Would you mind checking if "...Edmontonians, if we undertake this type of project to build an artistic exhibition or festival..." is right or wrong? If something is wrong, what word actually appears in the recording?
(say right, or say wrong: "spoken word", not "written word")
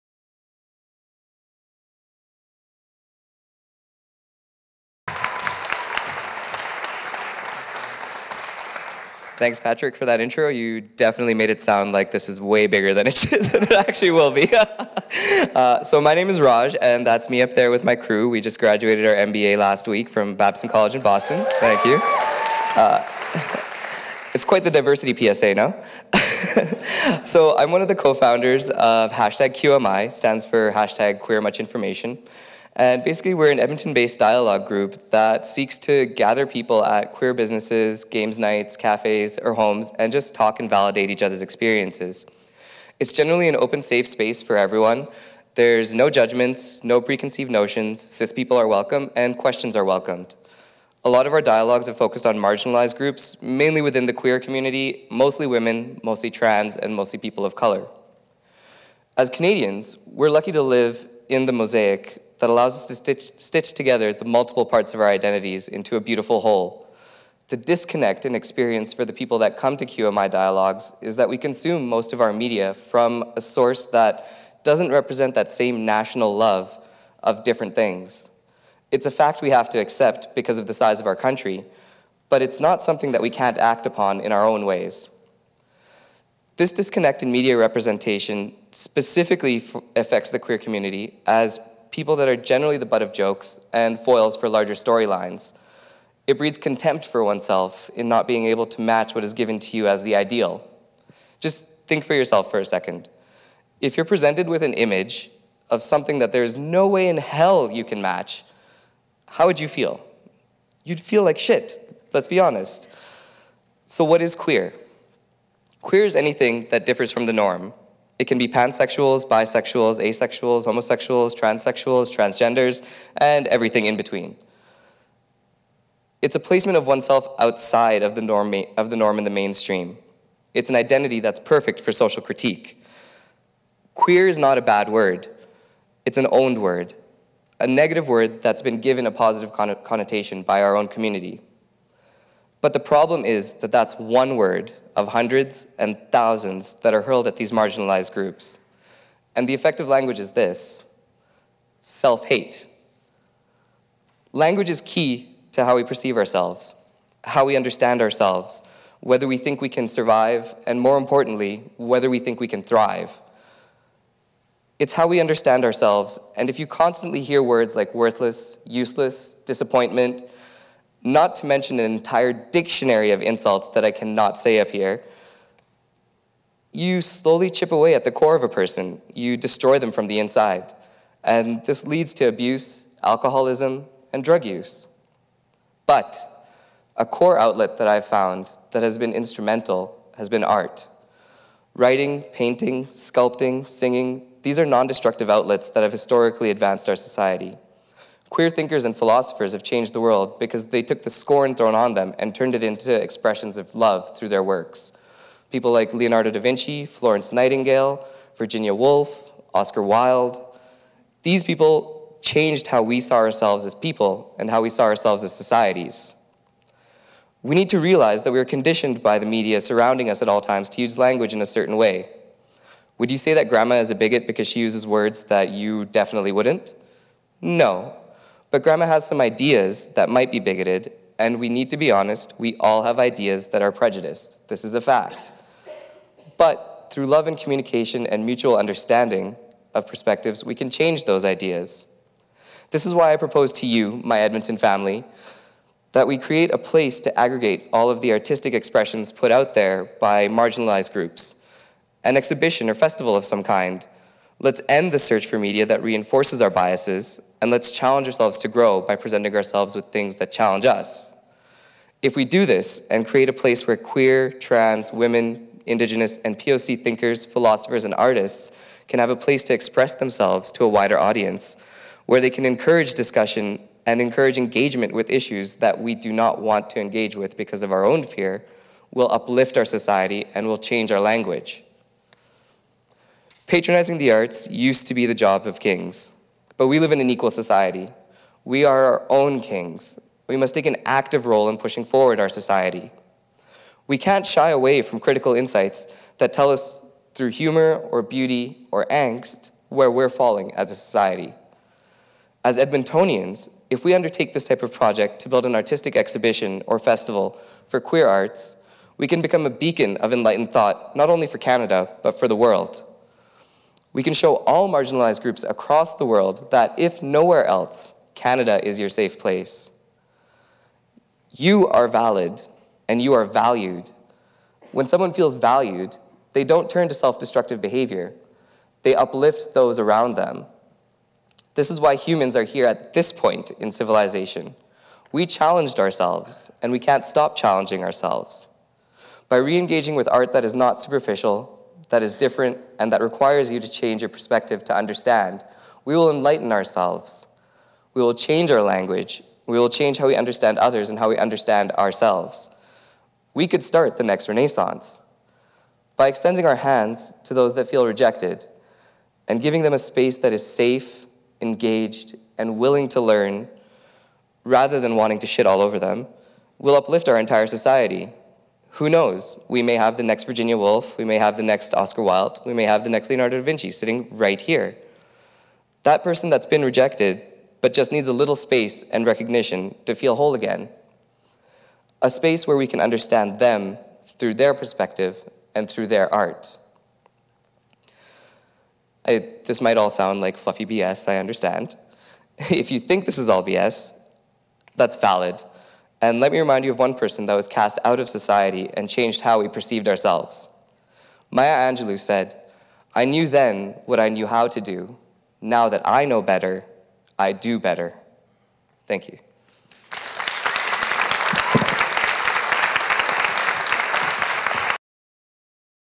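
right.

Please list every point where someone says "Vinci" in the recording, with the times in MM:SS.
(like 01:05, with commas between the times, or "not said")
03:26, 06:13.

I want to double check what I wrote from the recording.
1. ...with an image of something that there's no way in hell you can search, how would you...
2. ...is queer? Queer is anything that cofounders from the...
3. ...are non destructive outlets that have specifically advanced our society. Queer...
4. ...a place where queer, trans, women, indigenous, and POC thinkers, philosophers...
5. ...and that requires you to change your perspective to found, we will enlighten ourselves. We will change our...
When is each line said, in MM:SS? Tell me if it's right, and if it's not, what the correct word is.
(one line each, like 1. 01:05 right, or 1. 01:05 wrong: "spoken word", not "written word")
1. 01:44 wrong: "match", not "search"
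2. 01:54 wrong: "differs", not "cofounders"
3. 03:14 wrong: "historically", not "specifically"
4. 04:23 right
5. 05:42 wrong: "understand", not "found".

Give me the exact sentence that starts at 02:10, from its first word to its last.
It's an identity that's perfect for social critique.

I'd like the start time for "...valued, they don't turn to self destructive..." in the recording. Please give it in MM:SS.
05:25.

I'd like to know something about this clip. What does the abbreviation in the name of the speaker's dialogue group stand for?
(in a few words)
Queer Much Information.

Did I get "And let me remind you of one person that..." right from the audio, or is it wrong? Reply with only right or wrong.
right.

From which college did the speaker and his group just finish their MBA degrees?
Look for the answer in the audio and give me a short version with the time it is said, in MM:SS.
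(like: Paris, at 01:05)
Babson College, at 00:20.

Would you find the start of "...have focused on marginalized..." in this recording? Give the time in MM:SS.
00:51.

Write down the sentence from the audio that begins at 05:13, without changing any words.
We can show all marginalized groups across the world that if nowhere else, Canada is your safe place.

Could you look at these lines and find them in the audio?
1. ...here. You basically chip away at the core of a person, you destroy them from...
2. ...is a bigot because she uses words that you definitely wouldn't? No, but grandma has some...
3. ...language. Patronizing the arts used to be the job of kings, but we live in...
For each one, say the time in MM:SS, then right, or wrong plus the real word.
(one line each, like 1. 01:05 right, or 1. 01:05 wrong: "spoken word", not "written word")
1. 02:54 wrong: "slowly", not "basically"
2. 03:43 right
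3. 04:40 right.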